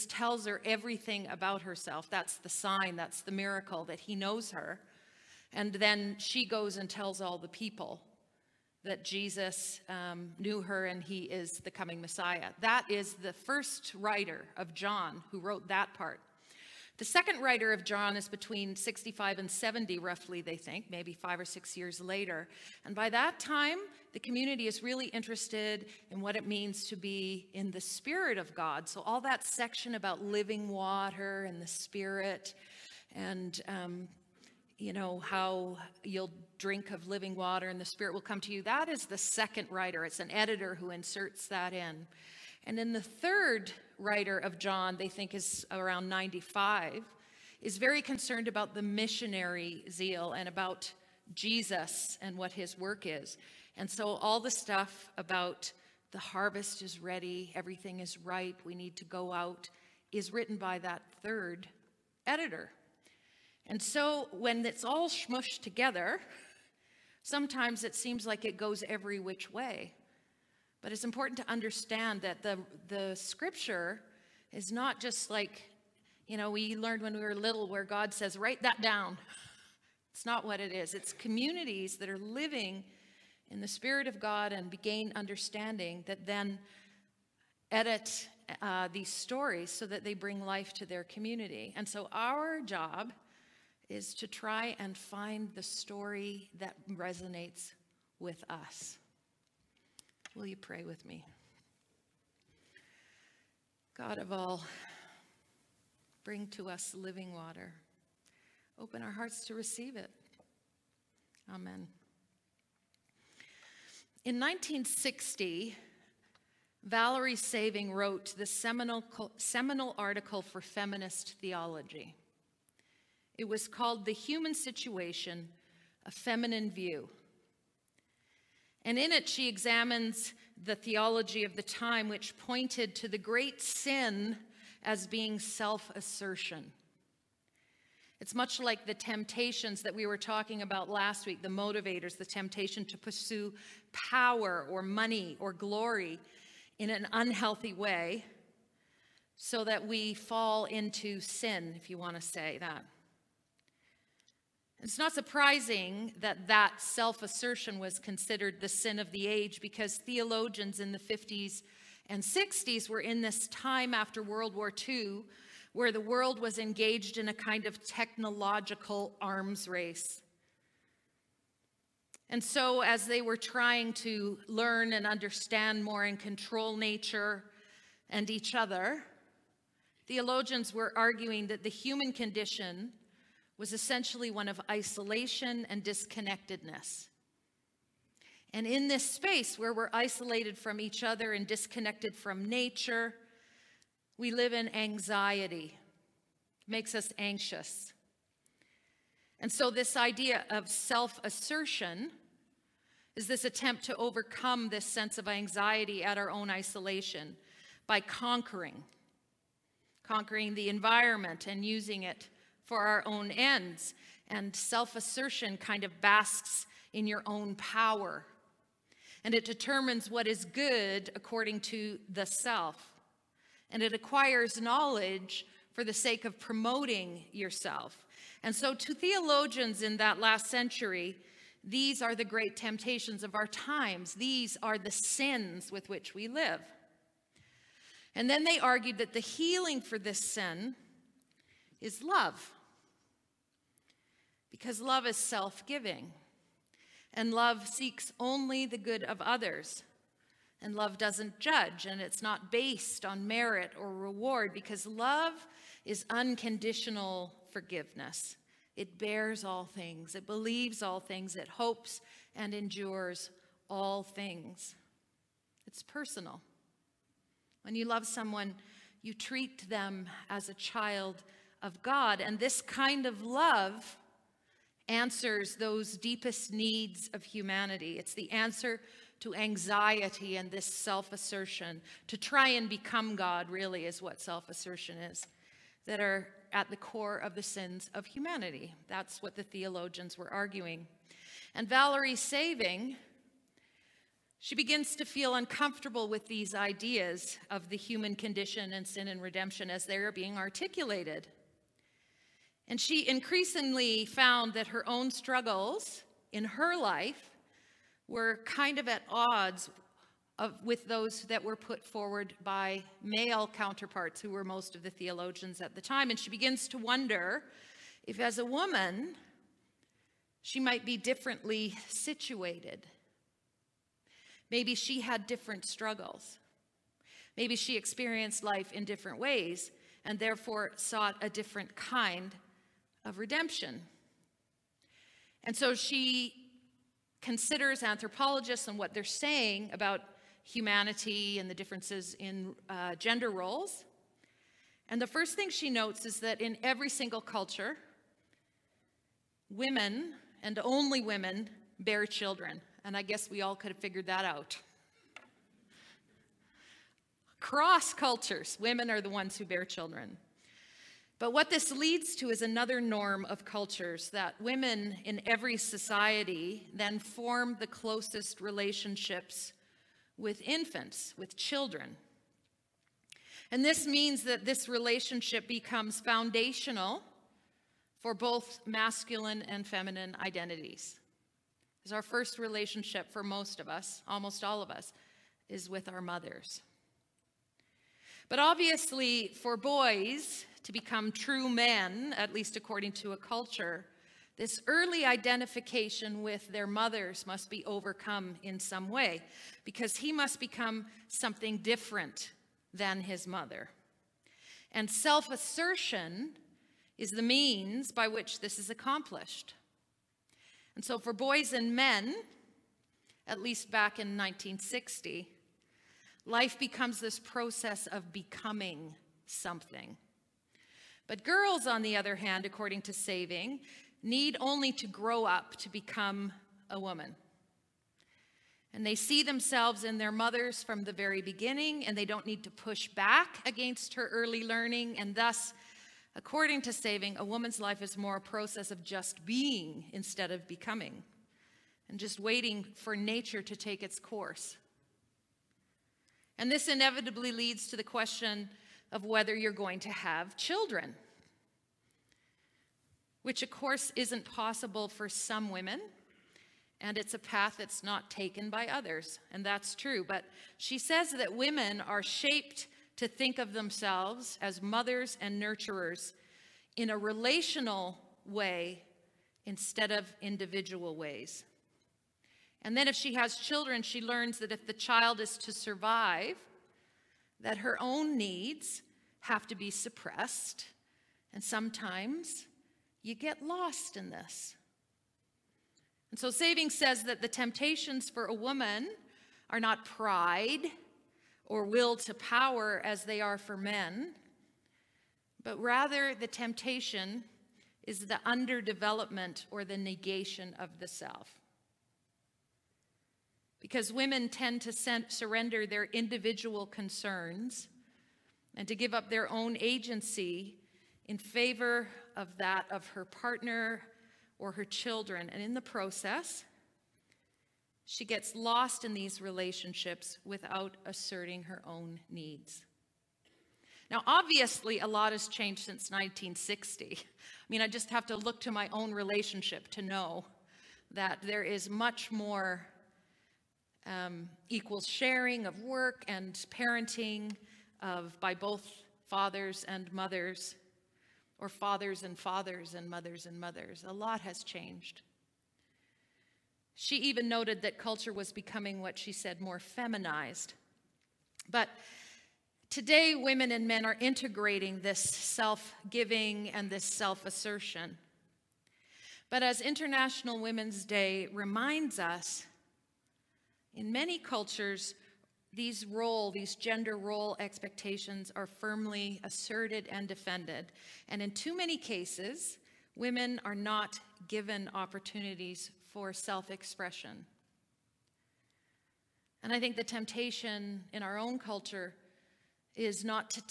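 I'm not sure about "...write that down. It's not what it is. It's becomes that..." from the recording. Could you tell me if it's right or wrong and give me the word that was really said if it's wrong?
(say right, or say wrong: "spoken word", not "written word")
wrong: "communities", not "becomes".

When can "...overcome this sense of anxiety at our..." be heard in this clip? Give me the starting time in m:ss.
3:23.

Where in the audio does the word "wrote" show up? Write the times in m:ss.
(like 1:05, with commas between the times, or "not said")
0:15, 1:57.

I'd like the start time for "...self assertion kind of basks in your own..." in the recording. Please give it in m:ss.
3:34.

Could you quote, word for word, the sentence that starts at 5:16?
And she begins to wonder if, as a woman, she might be differently situated.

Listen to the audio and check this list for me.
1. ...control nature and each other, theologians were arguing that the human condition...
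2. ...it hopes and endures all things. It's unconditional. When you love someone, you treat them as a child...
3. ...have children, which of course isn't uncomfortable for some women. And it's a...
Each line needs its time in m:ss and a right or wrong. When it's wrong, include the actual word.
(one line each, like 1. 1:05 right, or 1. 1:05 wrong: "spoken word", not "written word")
1. 2:56 right
2. 4:21 wrong: "personal", not "unconditional"
3. 7:29 wrong: "possible", not "uncomfortable".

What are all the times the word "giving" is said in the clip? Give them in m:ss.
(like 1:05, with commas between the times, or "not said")
4:05, 9:15.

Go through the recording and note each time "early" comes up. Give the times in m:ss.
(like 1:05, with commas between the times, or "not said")
6:34, 7:14.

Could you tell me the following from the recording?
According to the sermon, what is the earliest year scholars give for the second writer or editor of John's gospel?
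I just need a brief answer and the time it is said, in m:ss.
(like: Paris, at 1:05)
65, at 0:18.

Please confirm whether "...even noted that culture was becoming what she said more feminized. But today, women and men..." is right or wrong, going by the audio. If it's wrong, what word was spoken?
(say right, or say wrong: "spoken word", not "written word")
right.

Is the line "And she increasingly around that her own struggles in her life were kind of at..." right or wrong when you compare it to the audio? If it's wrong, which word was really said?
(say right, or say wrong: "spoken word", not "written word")
wrong: "found", not "around".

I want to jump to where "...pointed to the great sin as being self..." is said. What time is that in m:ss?
2:12.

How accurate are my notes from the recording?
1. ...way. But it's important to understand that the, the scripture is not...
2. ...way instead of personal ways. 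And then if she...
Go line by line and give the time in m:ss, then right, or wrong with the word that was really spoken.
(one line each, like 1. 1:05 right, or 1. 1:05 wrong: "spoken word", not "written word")
1. 1:09 right
2. 7:48 wrong: "individual", not "personal".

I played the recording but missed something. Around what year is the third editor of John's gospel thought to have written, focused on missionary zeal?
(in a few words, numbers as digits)
95.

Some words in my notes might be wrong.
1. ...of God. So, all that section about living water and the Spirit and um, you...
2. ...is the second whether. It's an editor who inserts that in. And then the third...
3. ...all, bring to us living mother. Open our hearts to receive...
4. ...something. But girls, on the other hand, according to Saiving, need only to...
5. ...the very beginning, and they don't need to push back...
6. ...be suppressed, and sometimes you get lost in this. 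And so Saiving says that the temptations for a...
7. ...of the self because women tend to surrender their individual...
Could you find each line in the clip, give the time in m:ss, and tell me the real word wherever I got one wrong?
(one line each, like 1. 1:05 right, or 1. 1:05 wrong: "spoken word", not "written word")
1. 0:28 right
2. 0:38 wrong: "writer", not "whether"
3. 1:44 wrong: "water", not "mother"
4. 6:59 right
5. 7:10 right
6. 7:59 right
7. 8:20 right.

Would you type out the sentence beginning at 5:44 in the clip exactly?
And the first thing she notes is that in every single culture, women and only women bear children.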